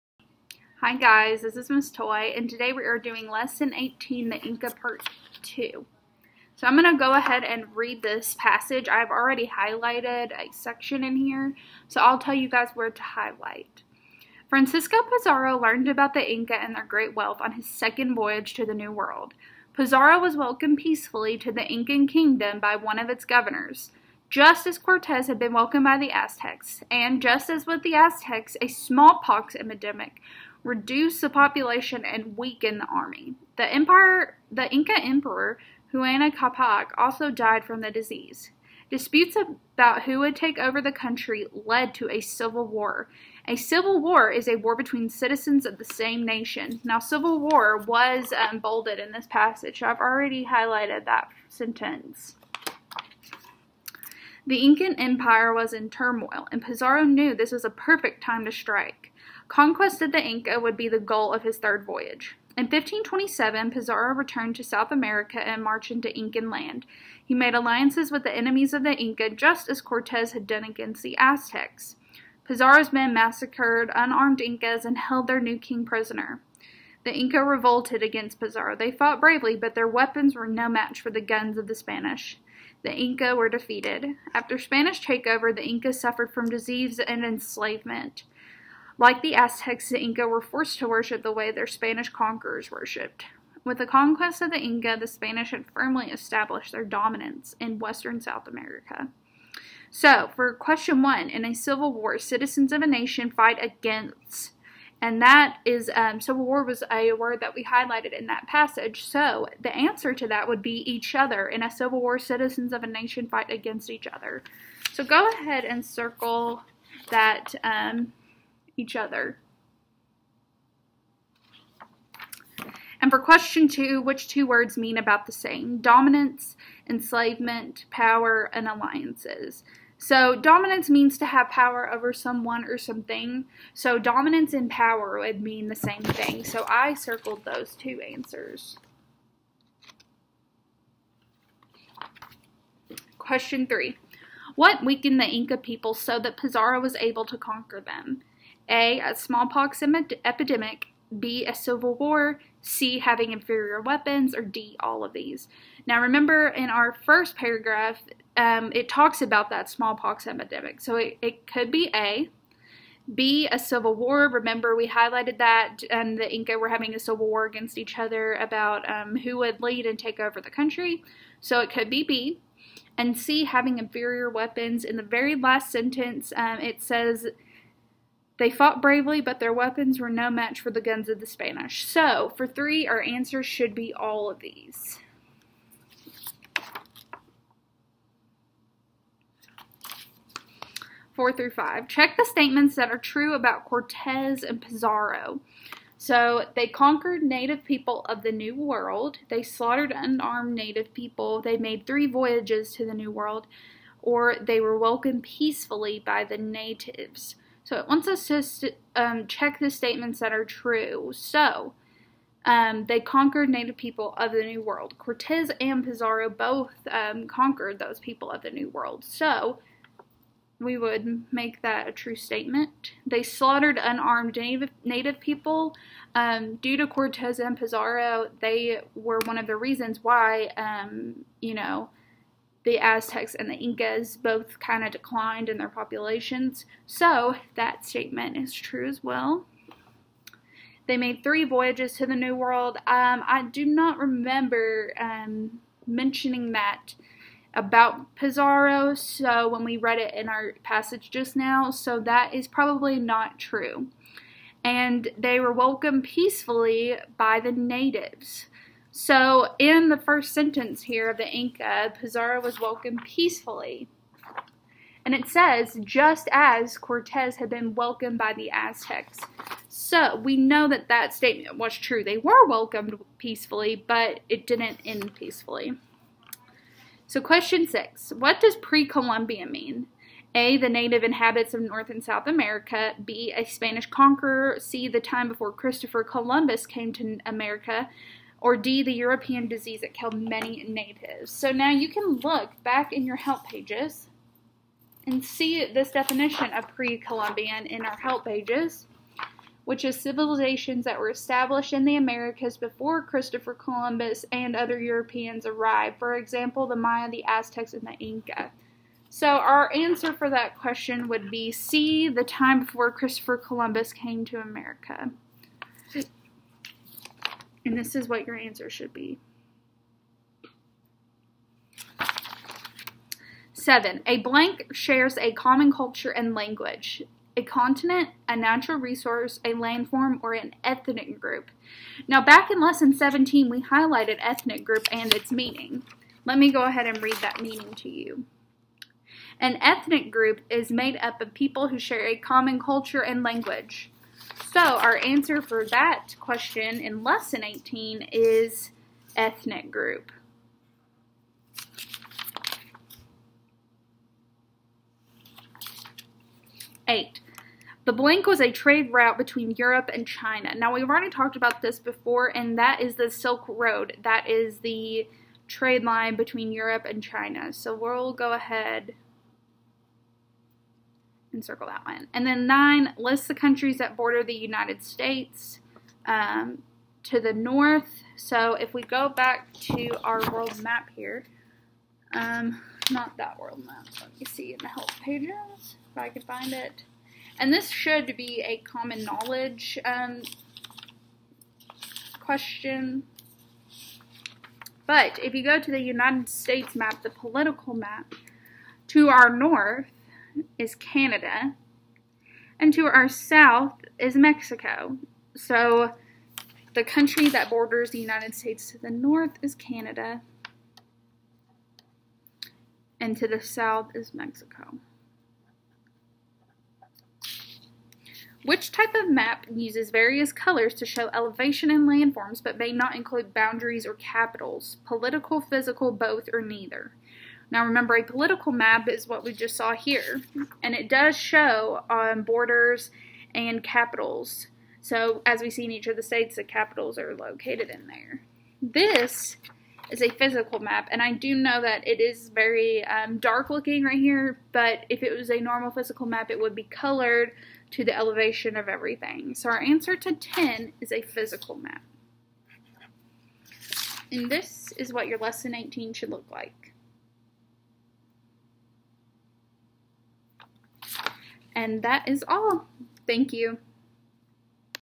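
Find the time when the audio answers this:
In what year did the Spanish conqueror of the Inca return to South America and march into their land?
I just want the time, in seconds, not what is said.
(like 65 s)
62 s.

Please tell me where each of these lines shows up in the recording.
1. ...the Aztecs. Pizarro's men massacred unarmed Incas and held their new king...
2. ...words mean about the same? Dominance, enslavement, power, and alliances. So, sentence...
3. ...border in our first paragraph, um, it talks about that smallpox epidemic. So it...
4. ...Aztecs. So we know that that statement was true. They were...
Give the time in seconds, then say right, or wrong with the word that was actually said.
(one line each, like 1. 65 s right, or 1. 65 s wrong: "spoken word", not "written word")
1. 71 s right
2. 124 s wrong: "dominance", not "sentence"
3. 155 s wrong: "remember", not "border"
4. 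268 s right.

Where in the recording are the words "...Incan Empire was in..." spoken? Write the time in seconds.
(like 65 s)
54 s.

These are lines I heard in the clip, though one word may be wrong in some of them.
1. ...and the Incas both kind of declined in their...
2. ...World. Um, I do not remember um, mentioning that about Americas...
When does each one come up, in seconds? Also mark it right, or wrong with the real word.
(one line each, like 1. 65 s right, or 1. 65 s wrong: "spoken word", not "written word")
1. 233 s right
2. 242 s wrong: "Pizarro", not "Americas".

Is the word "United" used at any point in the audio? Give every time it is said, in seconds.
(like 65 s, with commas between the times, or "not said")
374 s, 395 s, 407 s.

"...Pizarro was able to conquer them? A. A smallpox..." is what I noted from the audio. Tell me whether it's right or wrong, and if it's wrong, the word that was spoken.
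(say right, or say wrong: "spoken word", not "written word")
right.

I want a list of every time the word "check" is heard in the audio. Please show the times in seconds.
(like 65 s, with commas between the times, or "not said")
191 s, 209 s.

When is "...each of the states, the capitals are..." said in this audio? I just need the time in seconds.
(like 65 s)
435 s.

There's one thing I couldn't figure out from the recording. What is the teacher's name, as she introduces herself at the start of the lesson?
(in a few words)
Miss Toy.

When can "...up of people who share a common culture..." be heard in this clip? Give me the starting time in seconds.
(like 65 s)
340 s.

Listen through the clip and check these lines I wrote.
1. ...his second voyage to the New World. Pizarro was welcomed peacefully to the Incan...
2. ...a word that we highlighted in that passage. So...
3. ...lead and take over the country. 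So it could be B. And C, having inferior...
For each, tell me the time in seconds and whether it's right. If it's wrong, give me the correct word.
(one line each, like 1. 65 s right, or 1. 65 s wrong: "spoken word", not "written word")
1. 17 s right
2. 106 s right
3. 169 s right.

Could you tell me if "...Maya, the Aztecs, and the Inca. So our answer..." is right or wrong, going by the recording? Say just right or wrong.
right.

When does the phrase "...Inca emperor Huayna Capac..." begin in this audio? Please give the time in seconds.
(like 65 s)
34 s.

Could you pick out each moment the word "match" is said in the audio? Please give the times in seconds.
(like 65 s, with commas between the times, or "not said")
80 s, 180 s.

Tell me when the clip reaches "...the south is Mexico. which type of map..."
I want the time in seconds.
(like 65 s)
413 s.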